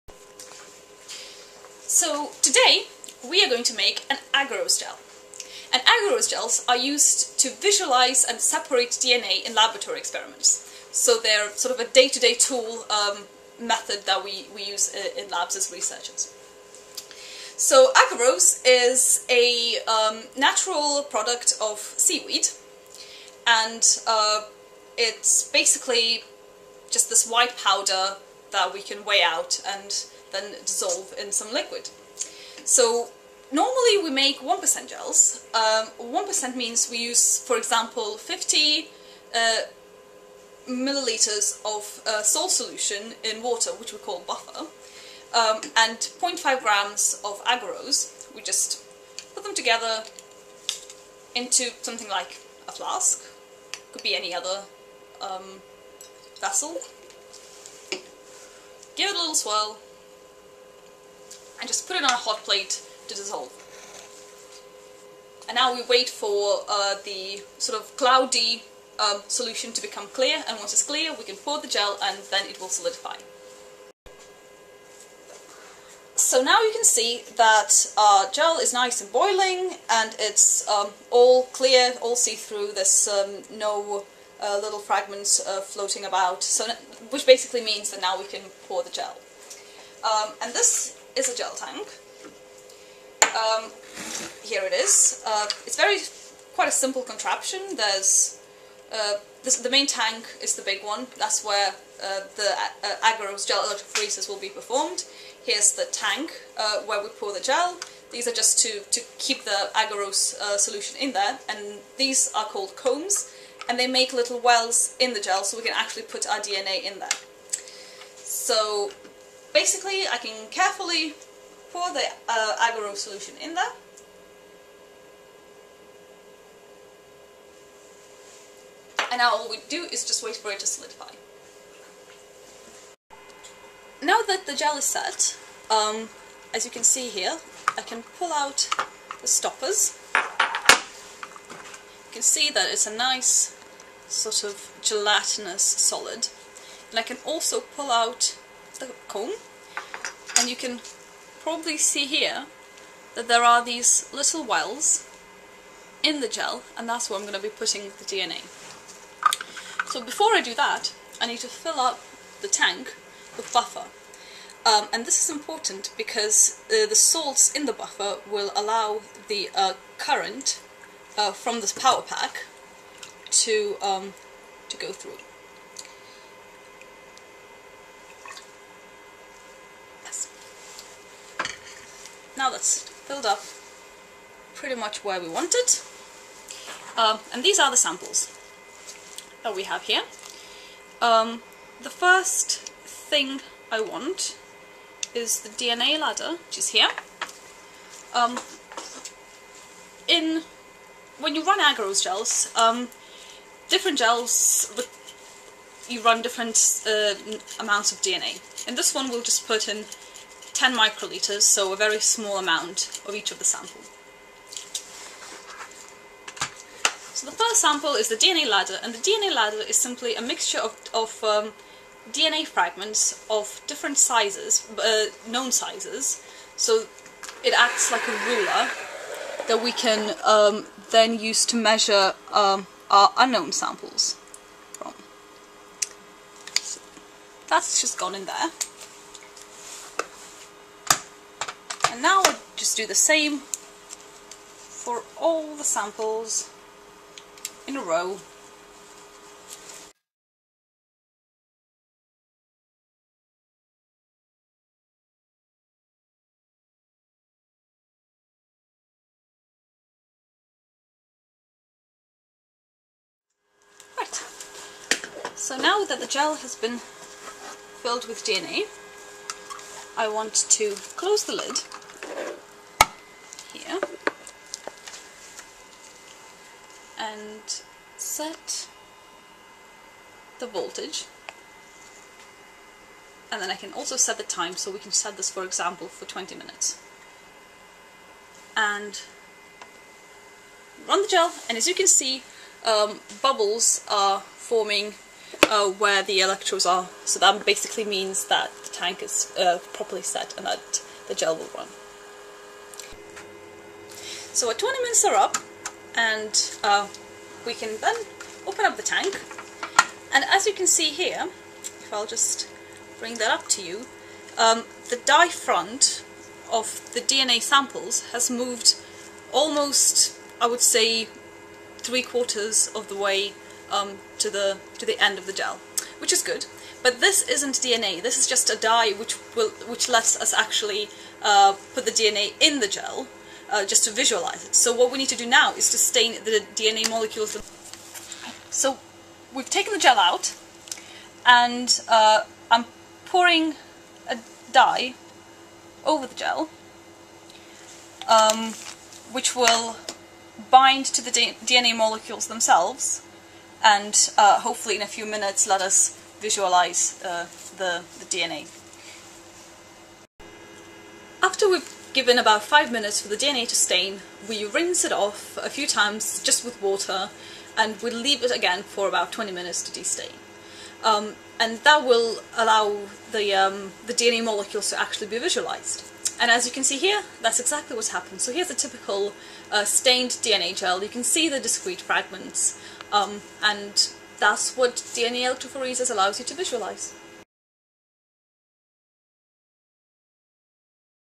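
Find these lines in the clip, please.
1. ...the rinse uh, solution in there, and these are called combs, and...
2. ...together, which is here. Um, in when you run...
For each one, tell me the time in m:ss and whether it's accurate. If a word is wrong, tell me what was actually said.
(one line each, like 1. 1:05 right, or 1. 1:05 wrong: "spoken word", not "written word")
1. 1:49 wrong: "agarose", not "rinse"
2. 3:15 wrong: "ladder", not "together".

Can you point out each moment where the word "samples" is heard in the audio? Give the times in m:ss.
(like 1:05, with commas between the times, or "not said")
3:07, 3:33, 3:37, 3:53, 4:05, 5:17.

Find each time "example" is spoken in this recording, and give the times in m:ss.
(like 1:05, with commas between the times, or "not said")
0:37, 4:45.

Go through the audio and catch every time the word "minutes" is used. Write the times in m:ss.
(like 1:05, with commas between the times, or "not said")
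4:46, 5:04, 5:55, 6:02, 6:09.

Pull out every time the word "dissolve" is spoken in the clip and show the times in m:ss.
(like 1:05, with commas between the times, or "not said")
0:30, 1:03.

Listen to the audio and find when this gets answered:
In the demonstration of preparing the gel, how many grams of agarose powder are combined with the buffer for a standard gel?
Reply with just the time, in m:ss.
0:45.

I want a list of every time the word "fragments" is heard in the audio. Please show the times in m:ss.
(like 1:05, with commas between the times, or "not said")
1:24, 3:42, 6:21.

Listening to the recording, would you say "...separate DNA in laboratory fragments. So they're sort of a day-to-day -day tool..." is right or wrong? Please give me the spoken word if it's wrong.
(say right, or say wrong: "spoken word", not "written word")
wrong: "experiments", not "fragments".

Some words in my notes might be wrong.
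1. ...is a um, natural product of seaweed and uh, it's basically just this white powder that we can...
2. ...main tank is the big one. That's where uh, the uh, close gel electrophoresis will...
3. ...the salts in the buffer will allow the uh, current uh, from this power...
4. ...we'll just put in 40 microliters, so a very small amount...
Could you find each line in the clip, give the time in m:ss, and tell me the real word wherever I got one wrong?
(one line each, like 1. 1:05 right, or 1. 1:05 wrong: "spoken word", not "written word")
1. 0:18 right
2. 1:39 wrong: "agarose", not "close"
3. 2:46 right
4. 3:29 wrong: "10", not "40".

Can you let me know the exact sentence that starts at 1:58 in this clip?
So Basically, I can carefully pour the uh, agarose solution in there.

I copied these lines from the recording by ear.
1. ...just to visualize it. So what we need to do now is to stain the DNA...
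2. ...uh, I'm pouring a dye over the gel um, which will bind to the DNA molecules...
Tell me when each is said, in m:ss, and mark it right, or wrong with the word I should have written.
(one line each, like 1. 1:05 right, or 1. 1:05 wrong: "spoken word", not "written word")
1. 5:33 right
2. 5:41 right.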